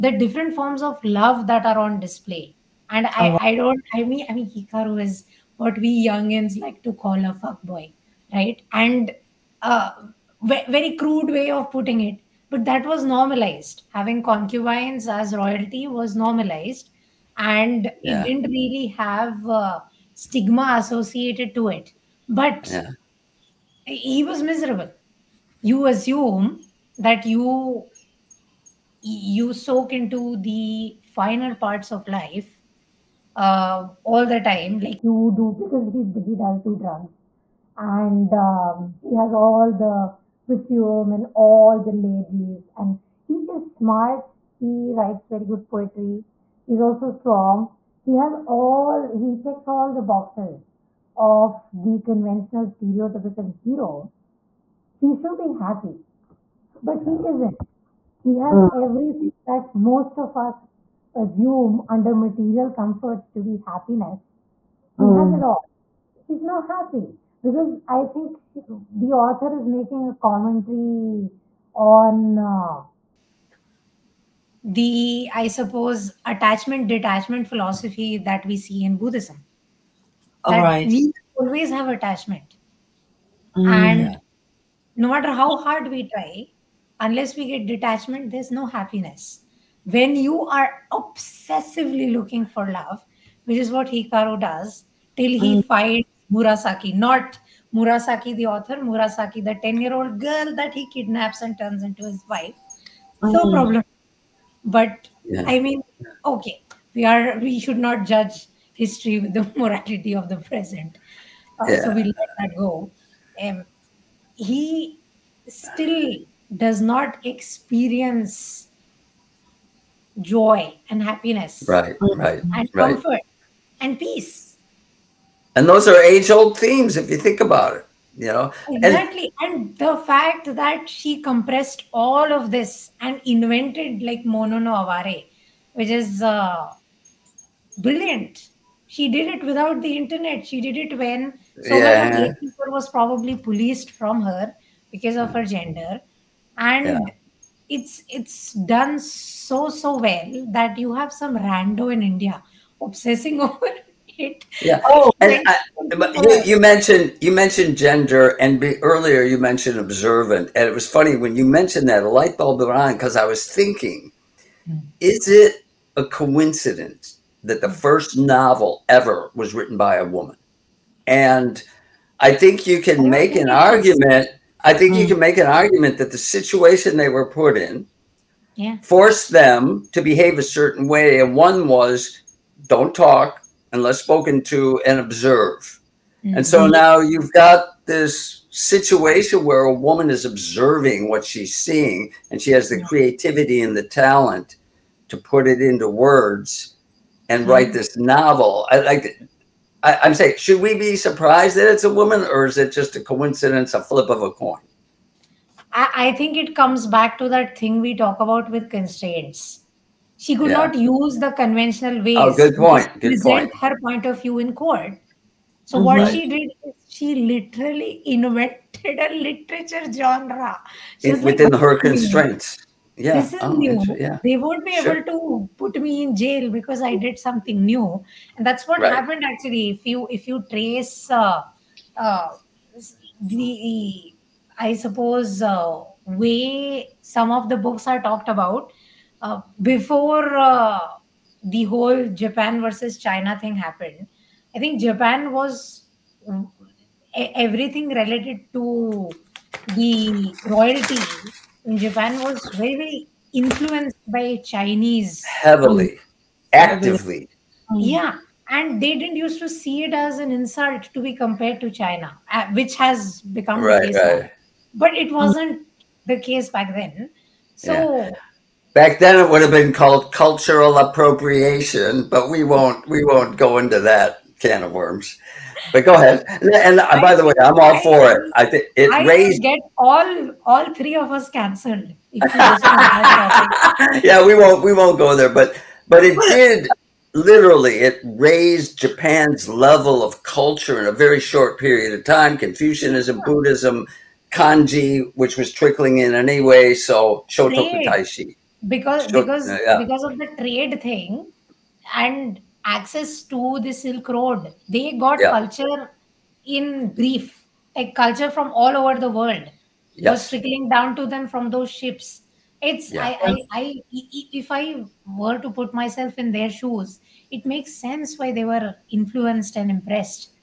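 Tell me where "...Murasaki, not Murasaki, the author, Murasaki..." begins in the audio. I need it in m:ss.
1:36.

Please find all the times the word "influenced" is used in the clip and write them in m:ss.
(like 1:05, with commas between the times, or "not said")
4:13, 5:18.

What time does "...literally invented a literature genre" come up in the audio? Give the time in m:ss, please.
3:37.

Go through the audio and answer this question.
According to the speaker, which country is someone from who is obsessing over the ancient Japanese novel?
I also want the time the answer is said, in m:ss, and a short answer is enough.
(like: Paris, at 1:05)
India, at 2:32.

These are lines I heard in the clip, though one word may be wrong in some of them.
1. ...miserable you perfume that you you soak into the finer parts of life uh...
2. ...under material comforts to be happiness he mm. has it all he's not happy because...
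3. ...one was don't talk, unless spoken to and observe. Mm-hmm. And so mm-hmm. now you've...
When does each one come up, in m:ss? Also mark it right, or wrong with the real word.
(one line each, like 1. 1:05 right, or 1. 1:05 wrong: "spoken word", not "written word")
1. 0:24 wrong: "assume", not "perfume"
2. 1:01 right
3. 3:01 right.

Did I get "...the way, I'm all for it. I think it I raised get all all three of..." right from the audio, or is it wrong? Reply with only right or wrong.
right.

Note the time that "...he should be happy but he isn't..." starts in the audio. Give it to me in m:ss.
0:54.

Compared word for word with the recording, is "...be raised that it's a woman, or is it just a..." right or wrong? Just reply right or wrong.
wrong.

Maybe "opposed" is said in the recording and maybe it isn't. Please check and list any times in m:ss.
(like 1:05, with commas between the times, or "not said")
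not said.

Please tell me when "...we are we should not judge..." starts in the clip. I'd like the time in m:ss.
1:46.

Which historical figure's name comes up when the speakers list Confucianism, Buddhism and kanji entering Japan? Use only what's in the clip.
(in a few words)
Shotoku Taishi.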